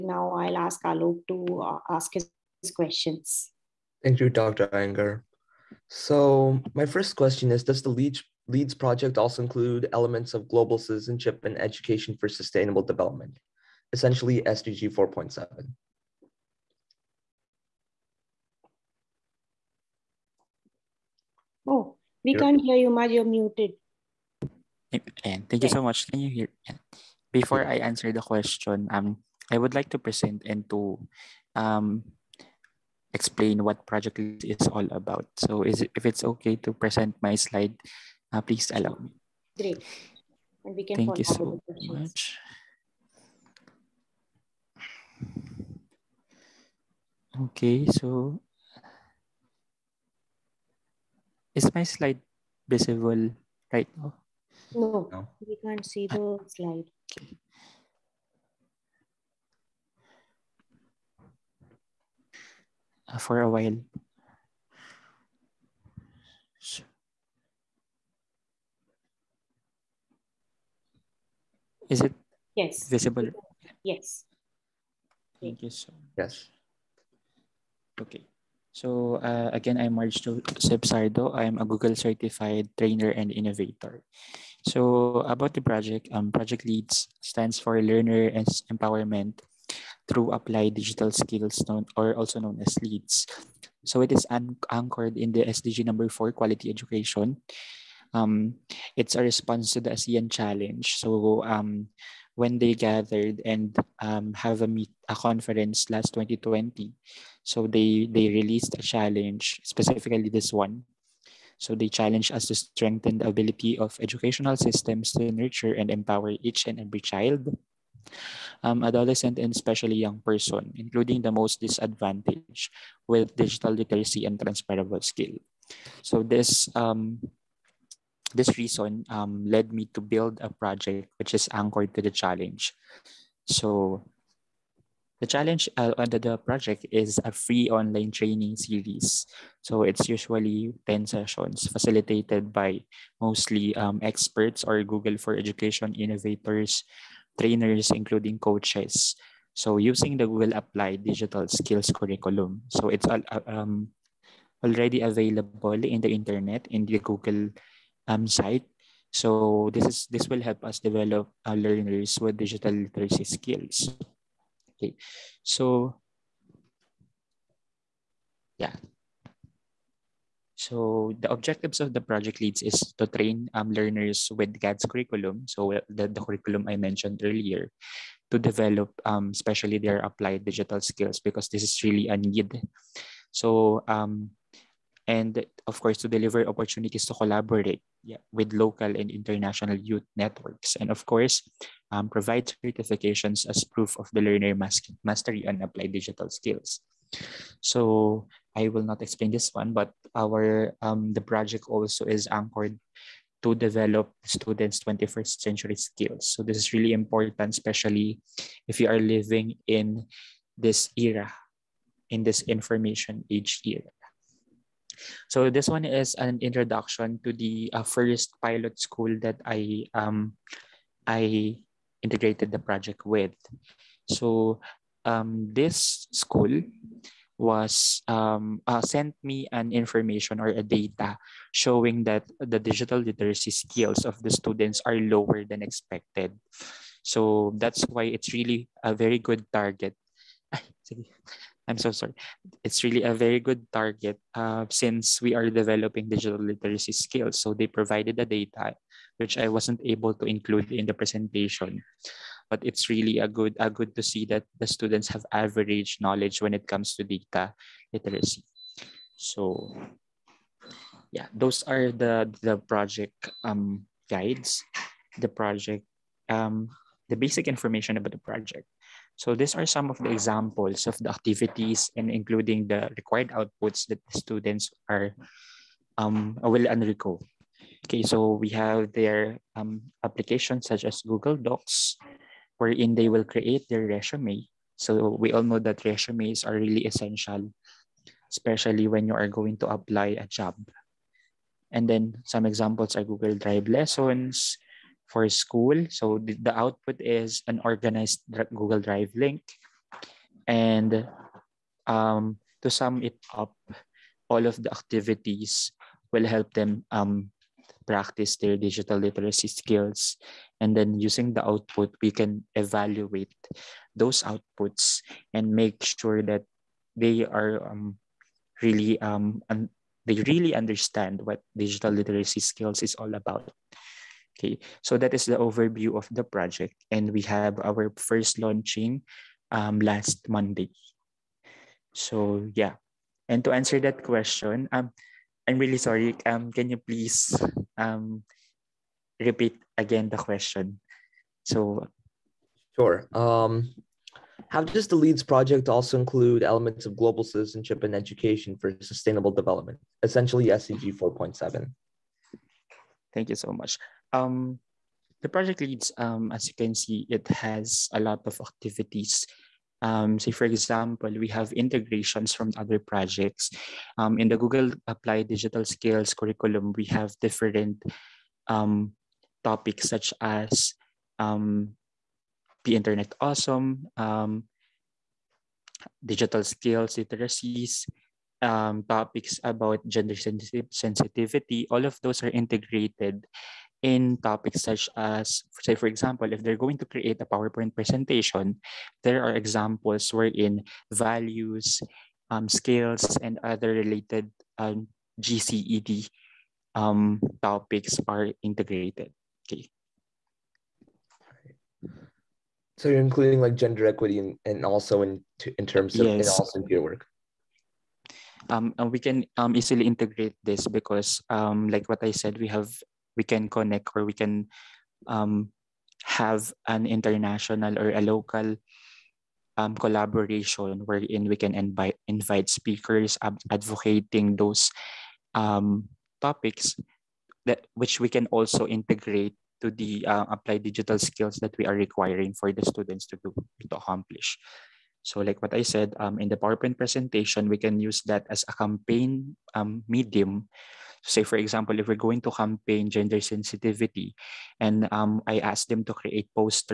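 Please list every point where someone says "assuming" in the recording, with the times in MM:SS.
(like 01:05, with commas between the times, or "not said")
not said.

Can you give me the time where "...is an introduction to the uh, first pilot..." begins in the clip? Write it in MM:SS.
03:35.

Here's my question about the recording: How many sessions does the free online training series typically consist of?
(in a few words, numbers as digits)
10.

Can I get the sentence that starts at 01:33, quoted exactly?
So it is anchored in the SDG number four, quality education.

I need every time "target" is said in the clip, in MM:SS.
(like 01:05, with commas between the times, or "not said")
03:59, 04:03.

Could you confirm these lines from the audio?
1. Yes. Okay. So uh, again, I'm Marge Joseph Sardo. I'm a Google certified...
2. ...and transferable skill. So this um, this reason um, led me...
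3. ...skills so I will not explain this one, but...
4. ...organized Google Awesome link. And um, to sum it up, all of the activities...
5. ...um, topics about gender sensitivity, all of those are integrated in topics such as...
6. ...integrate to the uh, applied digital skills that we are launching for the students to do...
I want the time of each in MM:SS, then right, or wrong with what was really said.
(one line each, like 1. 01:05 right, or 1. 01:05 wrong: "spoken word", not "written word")
1. 01:16 right
2. 02:04 right
3. 03:16 right
4. 04:57 wrong: "Drive", not "Awesome"
5. 06:18 right
6. 07:08 wrong: "requiring", not "launching".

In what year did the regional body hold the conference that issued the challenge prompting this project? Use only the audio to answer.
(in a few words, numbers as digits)
2020.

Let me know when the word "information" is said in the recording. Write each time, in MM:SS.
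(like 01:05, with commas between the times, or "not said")
03:32, 03:49, 04:27.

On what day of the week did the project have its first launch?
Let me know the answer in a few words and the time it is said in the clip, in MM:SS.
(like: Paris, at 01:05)
Monday, at 05:30.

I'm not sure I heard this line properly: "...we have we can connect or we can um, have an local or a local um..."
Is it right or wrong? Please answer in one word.
wrong.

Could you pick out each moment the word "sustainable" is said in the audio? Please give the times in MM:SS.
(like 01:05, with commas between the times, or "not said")
00:12, 05:48.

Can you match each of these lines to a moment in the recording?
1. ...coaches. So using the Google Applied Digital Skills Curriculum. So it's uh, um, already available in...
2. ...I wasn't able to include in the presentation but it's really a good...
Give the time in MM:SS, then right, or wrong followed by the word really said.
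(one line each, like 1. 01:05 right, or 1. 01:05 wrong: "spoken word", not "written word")
1. 02:28 right
2. 04:09 right.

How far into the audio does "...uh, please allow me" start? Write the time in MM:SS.
00:38.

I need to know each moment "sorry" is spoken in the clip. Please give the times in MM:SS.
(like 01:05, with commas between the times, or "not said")
04:01, 05:35.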